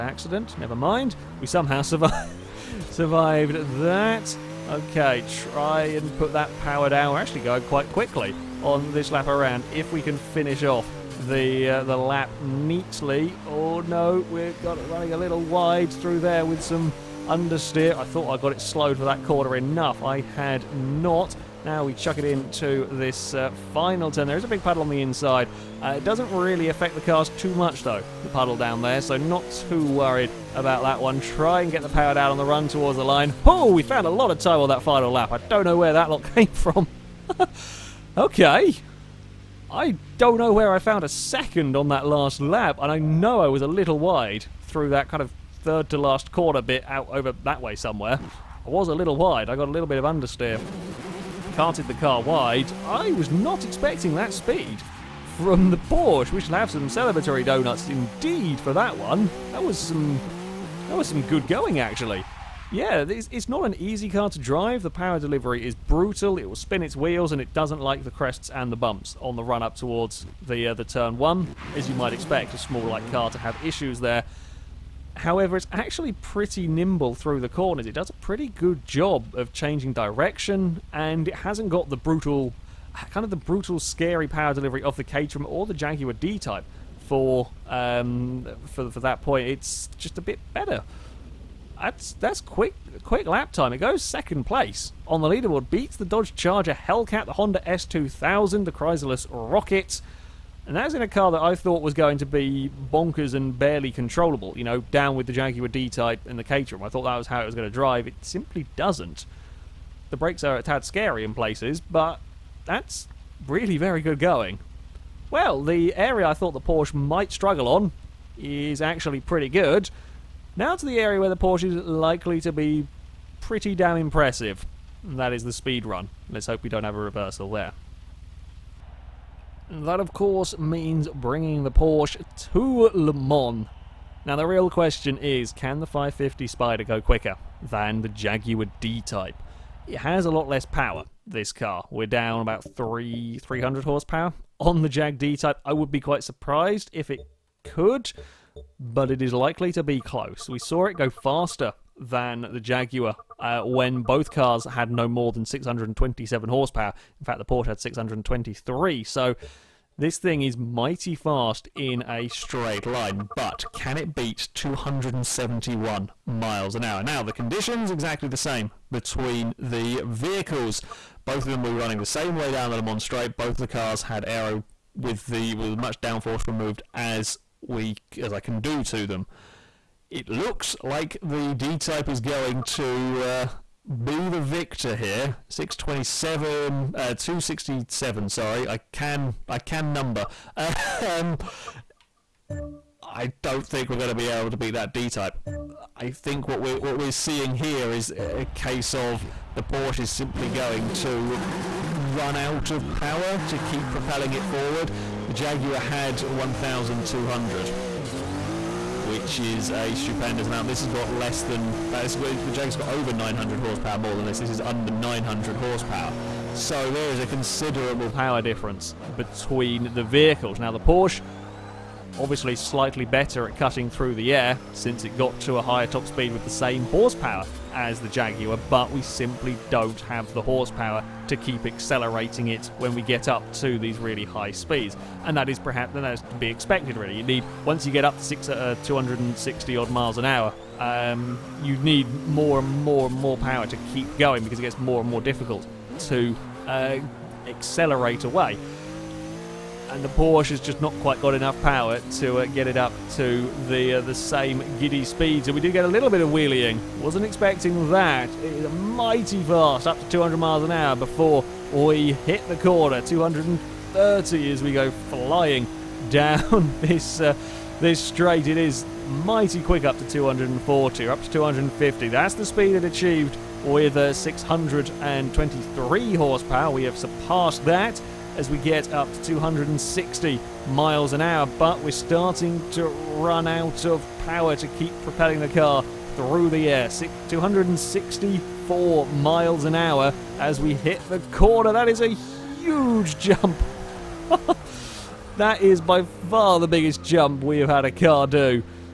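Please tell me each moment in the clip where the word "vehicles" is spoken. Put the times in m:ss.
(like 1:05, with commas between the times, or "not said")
2:50, 3:40.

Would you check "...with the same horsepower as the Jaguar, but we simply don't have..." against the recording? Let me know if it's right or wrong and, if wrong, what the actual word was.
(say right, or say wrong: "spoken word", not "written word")
right.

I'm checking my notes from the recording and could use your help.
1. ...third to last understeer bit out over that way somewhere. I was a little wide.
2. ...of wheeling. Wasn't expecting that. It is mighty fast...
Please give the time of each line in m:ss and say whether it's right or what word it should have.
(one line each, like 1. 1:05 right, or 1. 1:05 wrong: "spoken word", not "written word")
1. 0:45 wrong: "corner", not "understeer"
2. 4:16 right.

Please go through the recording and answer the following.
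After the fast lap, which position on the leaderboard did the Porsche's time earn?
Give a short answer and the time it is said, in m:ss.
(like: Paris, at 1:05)
Second place, at 1:34.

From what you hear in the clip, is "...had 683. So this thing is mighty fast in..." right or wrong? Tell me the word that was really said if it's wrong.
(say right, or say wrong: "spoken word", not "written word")
wrong: "623", not "683".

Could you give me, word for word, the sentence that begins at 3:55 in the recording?
And that is perhaps that is to be expected, really.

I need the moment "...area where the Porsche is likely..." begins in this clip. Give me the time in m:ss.
2:00.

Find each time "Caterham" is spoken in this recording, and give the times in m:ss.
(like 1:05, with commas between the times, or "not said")
1:25, 1:46.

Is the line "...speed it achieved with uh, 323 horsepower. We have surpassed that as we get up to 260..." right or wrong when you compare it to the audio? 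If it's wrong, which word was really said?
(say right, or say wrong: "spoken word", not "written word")
wrong: "623", not "323".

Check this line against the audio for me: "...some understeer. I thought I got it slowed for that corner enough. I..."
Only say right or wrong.
right.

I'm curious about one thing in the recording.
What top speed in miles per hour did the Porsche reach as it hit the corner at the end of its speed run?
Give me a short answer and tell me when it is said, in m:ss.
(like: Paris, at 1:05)
264, at 4:47.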